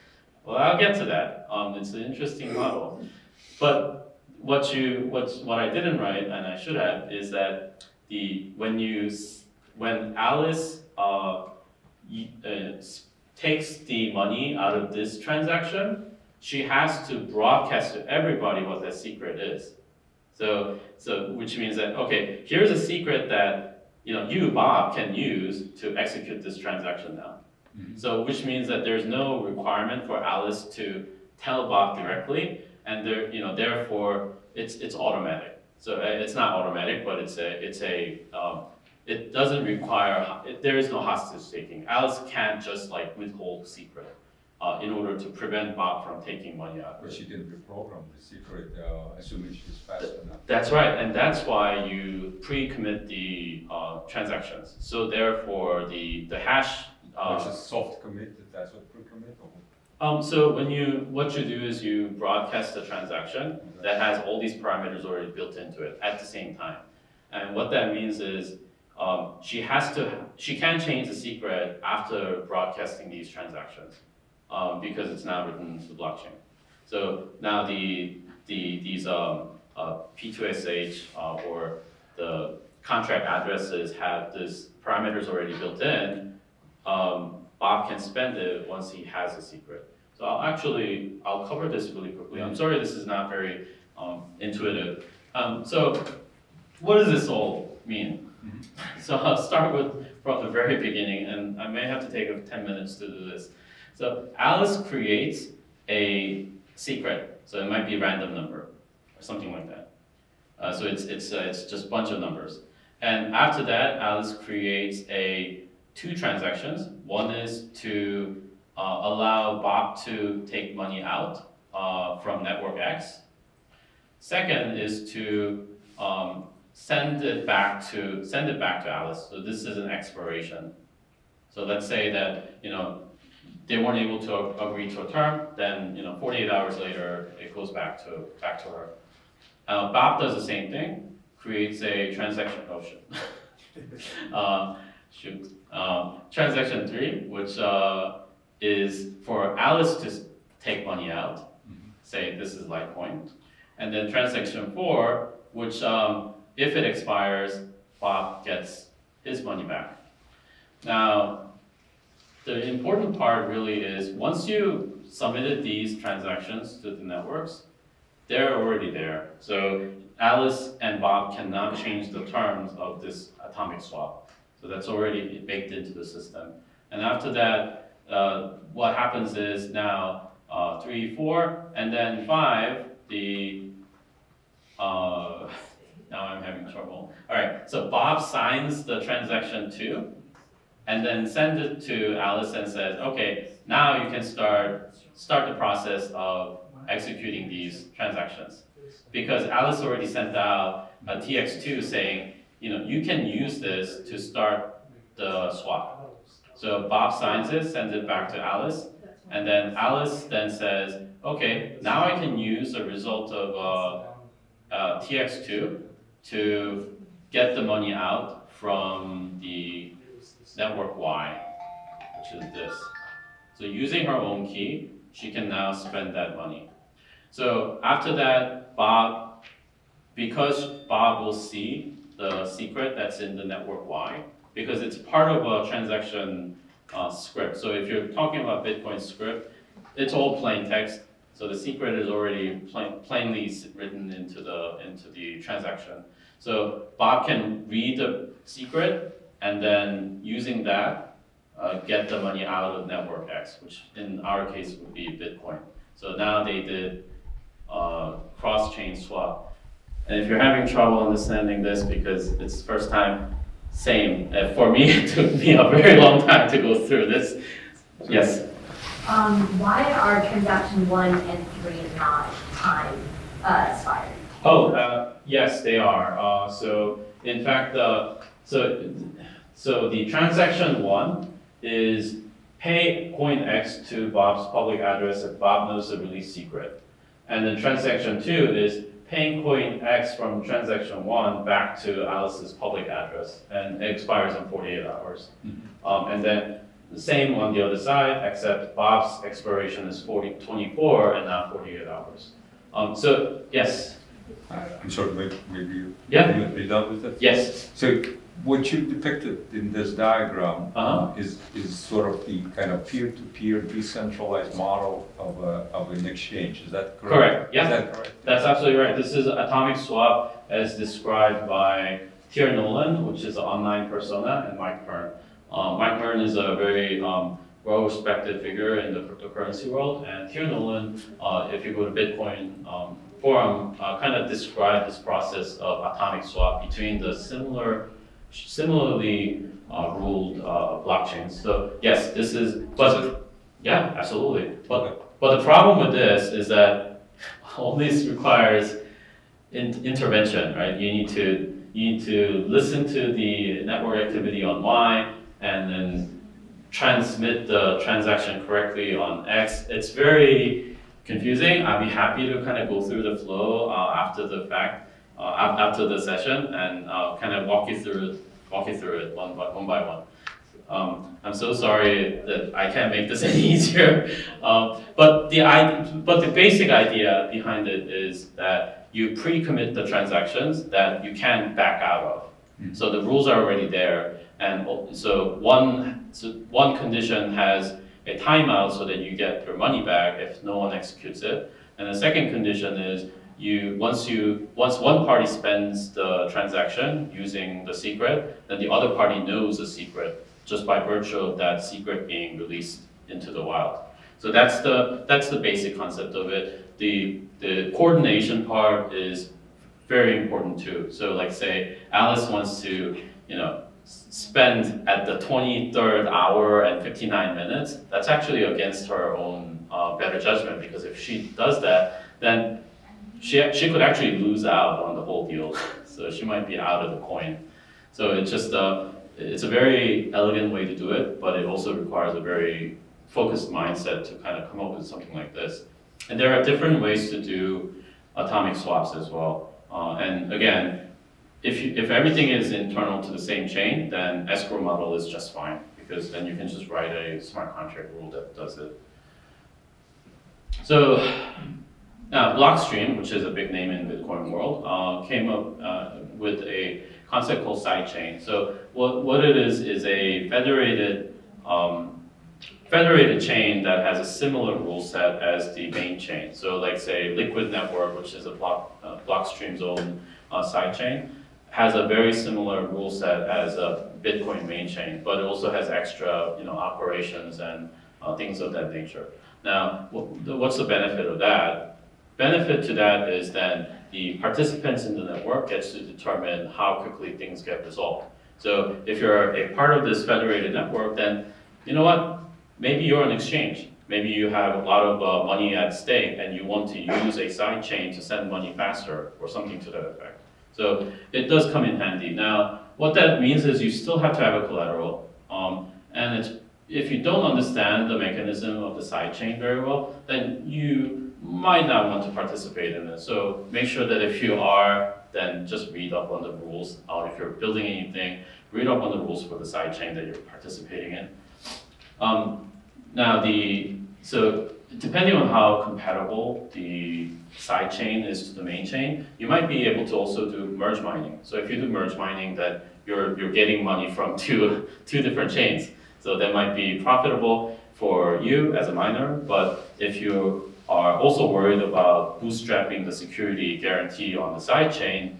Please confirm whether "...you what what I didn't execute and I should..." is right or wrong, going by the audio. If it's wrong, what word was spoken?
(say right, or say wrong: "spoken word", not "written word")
wrong: "write", not "execute".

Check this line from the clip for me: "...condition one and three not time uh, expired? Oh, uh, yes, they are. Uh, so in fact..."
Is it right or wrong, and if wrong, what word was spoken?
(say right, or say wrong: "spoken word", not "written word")
wrong: "transaction", not "condition".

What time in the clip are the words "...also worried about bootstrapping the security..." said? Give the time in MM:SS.
09:00.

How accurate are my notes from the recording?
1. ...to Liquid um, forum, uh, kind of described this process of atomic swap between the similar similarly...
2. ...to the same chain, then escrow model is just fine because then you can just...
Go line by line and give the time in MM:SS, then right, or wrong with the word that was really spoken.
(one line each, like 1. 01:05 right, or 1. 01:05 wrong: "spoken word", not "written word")
1. 05:31 wrong: "Bitcoin", not "Liquid"
2. 07:23 right.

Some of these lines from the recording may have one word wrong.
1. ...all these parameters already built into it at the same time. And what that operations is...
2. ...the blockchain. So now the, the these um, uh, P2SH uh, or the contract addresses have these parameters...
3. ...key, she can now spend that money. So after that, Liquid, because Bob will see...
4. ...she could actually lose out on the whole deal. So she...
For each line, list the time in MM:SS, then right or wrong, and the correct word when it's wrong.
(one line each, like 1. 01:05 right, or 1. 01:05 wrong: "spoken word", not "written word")
1. 01:04 wrong: "means", not "operations"
2. 01:15 right
3. 03:44 wrong: "Bob", not "Liquid"
4. 07:03 right.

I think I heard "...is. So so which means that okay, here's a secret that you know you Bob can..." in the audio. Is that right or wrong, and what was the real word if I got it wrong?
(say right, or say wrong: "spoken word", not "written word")
right.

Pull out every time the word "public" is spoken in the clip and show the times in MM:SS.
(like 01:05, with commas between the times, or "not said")
04:44, 04:52.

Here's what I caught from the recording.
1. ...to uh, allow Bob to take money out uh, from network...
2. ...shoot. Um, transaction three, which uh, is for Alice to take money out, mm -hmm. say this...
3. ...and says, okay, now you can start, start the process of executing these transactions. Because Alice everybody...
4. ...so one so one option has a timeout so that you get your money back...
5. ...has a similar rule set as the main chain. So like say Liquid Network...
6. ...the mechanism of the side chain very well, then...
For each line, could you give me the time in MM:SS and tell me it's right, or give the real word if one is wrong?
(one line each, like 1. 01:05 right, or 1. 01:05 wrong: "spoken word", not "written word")
1. 01:57 right
2. 02:25 right
3. 03:12 wrong: "already", not "everybody"
4. 06:24 wrong: "condition", not "option"
5. 07:43 right
6. 08:27 right.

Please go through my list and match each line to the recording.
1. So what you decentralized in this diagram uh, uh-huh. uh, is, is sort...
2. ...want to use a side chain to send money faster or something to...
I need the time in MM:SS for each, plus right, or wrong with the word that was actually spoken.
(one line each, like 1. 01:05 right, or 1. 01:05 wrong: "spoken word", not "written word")
1. 05:07 wrong: "depicted", not "decentralized"
2. 08:16 right.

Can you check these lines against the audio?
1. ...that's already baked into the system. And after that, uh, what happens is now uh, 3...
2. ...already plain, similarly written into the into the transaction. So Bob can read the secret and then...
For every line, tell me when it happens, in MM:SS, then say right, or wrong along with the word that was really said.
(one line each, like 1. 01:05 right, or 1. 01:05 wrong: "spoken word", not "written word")
1. 02:54 right
2. 04:02 wrong: "plainly", not "similarly".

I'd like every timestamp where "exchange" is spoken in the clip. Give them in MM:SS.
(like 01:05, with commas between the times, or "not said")
05:16, 08:13.